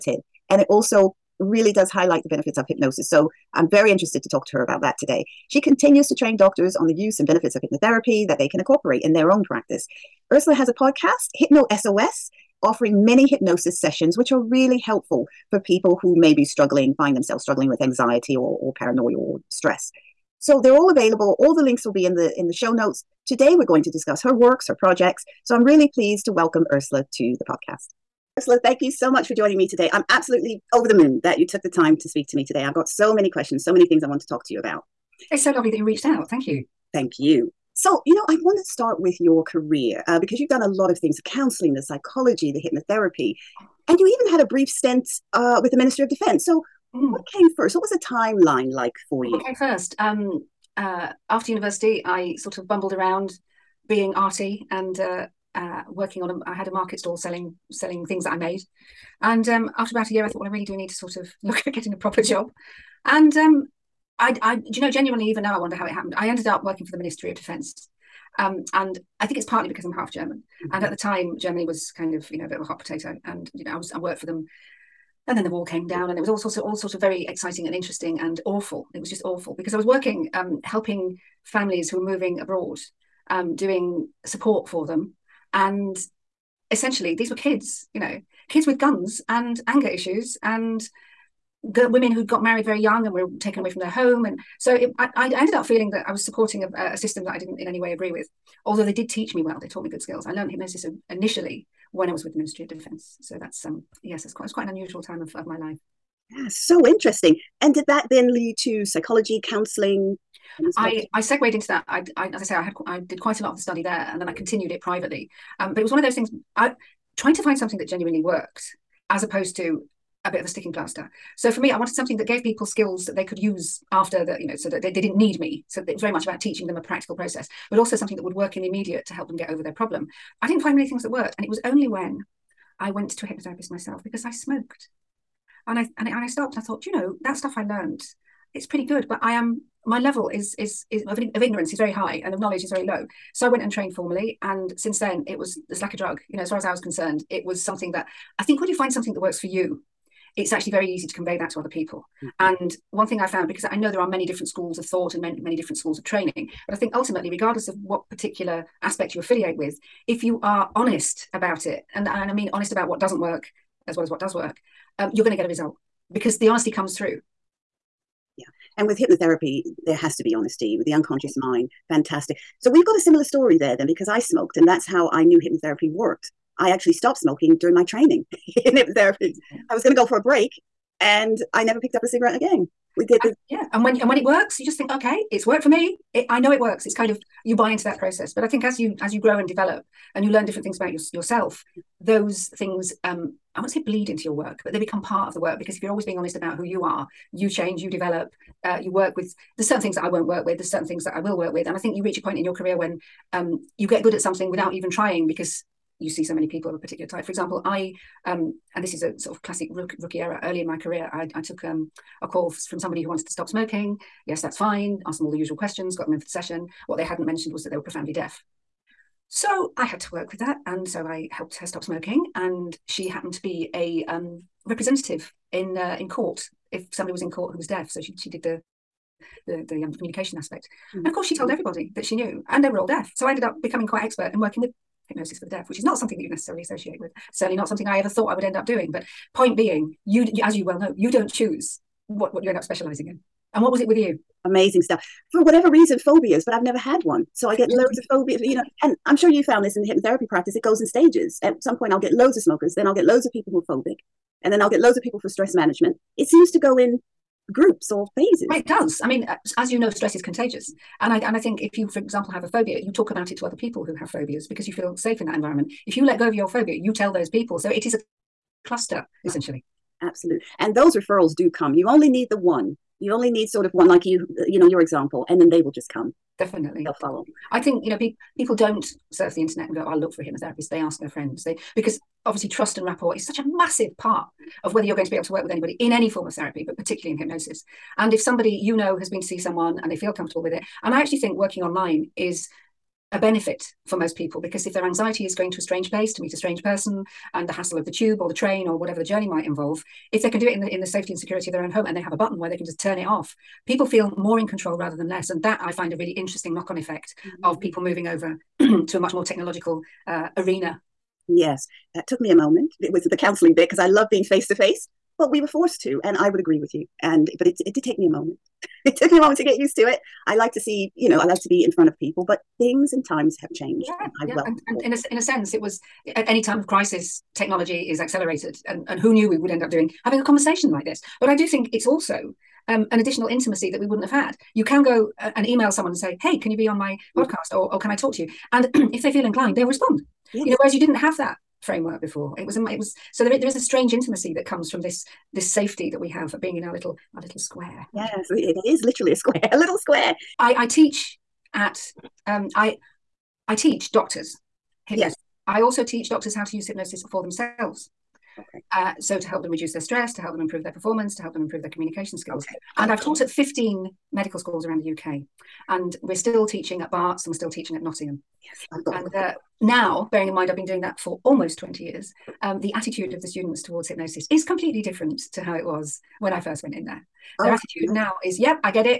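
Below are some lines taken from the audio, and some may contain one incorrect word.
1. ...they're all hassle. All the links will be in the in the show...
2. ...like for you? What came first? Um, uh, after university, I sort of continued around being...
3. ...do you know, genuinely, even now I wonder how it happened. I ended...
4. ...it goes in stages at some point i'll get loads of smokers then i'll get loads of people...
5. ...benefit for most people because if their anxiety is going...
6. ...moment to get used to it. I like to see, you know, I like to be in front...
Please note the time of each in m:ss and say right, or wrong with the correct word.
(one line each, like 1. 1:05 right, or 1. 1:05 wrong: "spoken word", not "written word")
1. 0:20 wrong: "available", not "hassle"
2. 0:48 wrong: "bumbled", not "continued"
3. 1:04 right
4. 4:10 right
5. 4:53 right
6. 5:19 right.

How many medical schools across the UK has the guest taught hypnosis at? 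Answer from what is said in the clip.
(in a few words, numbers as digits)
15.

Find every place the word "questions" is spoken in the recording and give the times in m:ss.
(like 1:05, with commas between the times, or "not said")
0:33, 3:35.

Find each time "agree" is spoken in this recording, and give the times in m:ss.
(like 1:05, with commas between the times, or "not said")
1:37, 5:16.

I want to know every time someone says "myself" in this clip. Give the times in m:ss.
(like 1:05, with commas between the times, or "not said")
2:13.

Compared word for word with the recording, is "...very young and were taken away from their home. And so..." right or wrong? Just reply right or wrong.
right.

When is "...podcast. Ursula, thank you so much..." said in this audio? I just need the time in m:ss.
0:27.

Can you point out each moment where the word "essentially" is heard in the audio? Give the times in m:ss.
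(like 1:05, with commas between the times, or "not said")
1:26, 4:29.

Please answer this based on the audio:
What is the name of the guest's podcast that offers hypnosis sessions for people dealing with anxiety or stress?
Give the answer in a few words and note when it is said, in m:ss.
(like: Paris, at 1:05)
Hypno SOS, at 0:11.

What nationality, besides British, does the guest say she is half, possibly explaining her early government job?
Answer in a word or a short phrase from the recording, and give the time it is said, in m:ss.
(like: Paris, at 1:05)
German, at 1:09.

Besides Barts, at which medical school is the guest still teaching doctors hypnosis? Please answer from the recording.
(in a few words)
Nottingham.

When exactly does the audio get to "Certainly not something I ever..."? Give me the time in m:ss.
3:57.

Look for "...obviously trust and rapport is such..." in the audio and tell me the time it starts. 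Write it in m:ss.
4:42.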